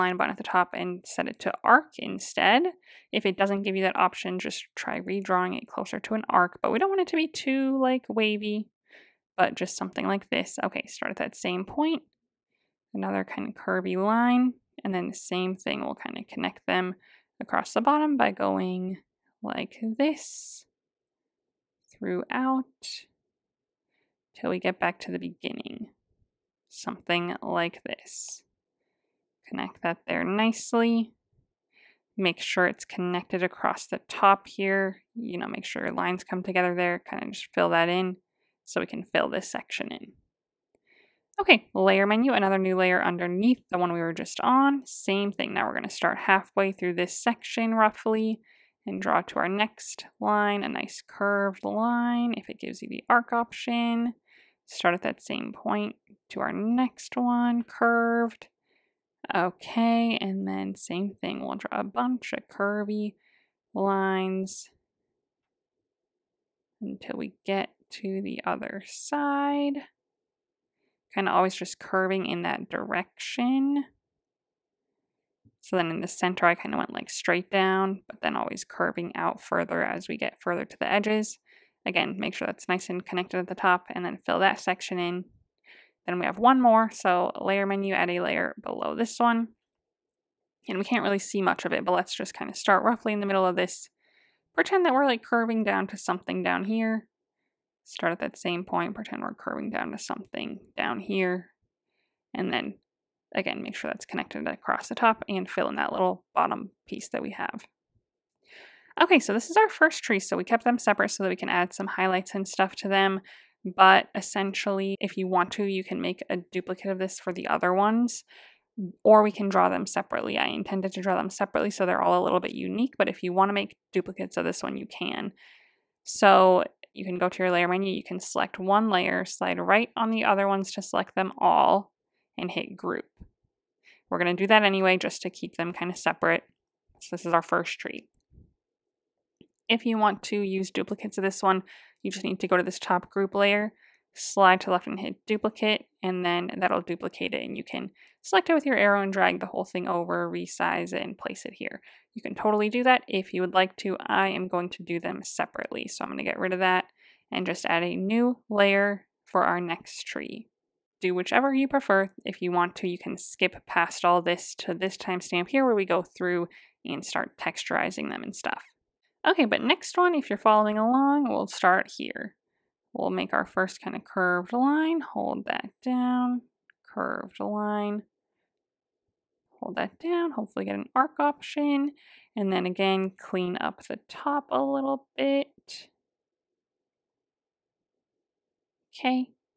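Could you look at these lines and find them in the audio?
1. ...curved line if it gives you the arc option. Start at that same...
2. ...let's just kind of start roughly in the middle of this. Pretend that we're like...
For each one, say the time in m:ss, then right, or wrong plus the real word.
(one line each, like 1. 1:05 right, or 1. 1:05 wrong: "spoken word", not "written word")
1. 0:51 right
2. 1:31 right.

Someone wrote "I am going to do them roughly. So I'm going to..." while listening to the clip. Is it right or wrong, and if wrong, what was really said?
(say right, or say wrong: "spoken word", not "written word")
wrong: "separately", not "roughly".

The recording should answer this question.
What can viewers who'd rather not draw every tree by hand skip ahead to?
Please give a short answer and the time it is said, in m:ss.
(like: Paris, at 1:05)
timestamp, at 2:44.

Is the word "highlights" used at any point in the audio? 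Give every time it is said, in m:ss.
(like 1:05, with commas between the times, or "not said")
1:51.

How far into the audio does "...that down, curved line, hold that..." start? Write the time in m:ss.
2:55.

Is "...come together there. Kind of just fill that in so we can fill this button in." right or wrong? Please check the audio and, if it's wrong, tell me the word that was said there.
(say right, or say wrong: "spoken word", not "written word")
wrong: "section", not "button".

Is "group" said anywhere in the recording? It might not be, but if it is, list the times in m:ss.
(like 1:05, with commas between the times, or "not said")
2:12, 2:23.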